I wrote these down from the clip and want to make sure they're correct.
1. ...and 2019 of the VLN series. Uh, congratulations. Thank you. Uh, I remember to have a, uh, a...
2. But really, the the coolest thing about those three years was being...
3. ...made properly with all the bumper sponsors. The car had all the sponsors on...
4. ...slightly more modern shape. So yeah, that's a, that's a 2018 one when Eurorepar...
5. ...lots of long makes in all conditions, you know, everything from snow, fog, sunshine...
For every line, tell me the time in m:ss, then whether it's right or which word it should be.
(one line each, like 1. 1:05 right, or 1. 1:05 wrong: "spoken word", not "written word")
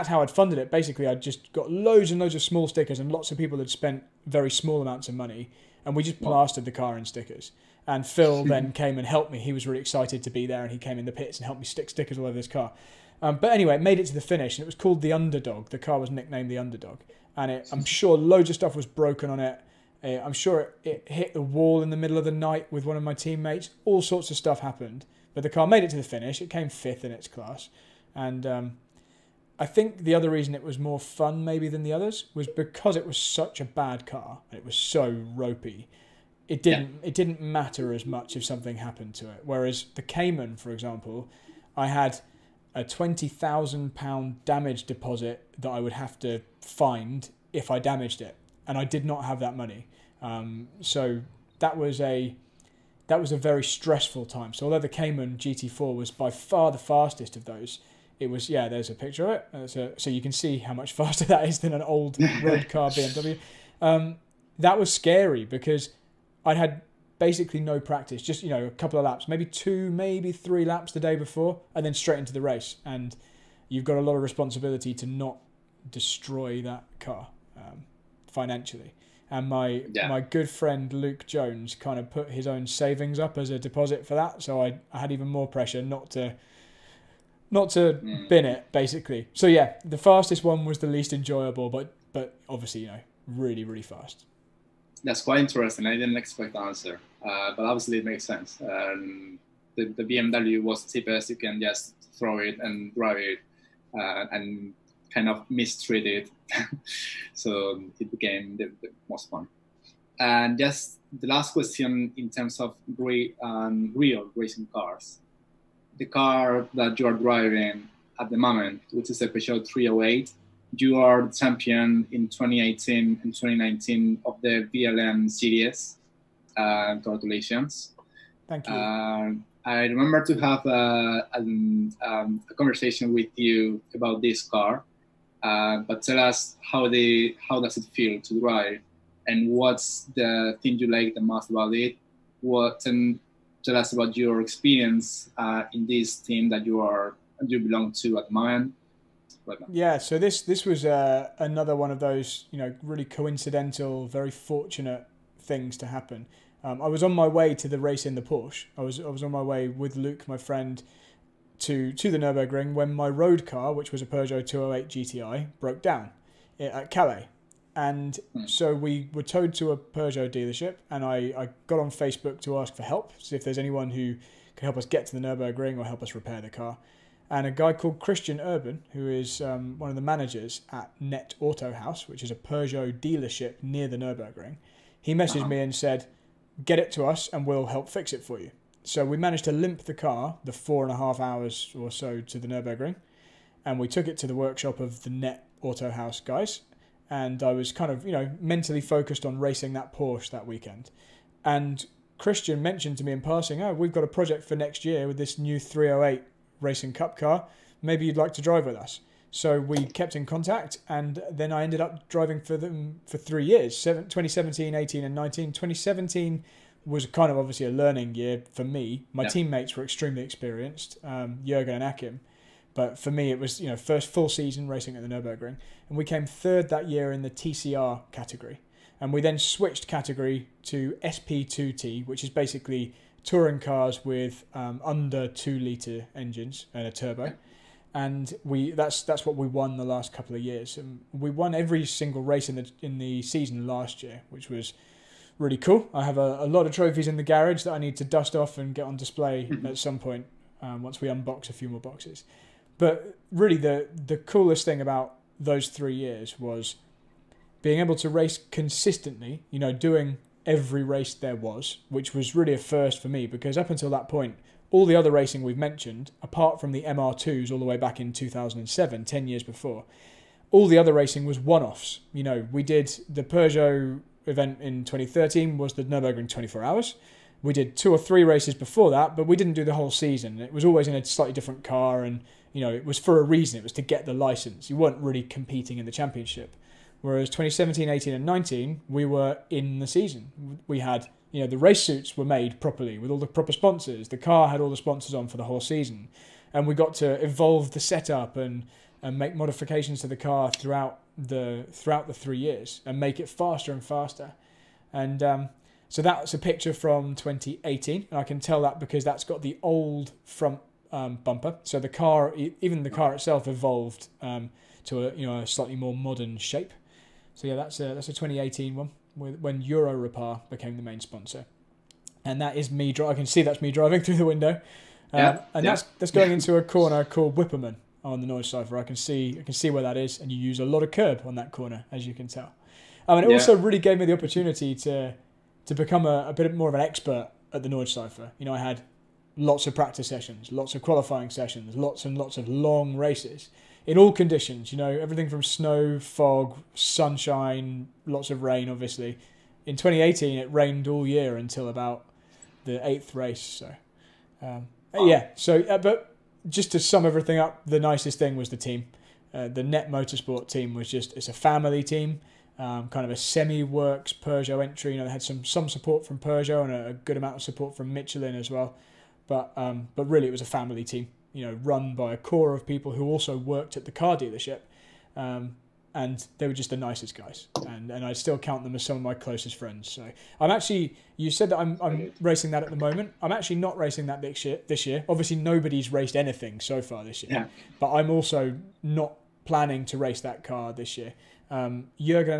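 1. 2:03 right
2. 4:12 right
3. 4:52 wrong: "proper", not "bumper"
4. 5:15 right
5. 5:42 wrong: "races", not "makes".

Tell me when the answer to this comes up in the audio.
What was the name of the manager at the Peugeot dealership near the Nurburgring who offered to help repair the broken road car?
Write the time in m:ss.
2:57.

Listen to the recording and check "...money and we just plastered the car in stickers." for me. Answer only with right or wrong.
right.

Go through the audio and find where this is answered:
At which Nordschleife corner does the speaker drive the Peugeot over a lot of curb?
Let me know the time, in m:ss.
5:27.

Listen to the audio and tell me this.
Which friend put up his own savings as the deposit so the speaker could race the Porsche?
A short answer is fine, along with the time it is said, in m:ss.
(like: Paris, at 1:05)
Luke Jones, at 1:20.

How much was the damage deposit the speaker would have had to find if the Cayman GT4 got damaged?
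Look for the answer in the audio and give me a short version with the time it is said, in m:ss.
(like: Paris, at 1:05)
£20,000, at 0:42.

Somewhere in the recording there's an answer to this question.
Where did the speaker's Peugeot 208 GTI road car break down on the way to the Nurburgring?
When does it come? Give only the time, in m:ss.
2:46.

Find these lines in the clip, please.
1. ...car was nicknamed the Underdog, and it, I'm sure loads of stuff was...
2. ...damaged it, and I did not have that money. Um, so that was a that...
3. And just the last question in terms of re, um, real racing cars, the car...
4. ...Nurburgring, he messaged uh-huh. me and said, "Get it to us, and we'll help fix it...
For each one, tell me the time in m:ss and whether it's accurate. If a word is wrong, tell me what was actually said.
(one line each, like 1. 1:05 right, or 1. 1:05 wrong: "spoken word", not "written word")
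1. 0:15 right
2. 0:47 right
3. 1:50 right
4. 3:03 right.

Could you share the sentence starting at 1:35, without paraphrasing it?
I didn't expect the answer, uh, but obviously it makes sense.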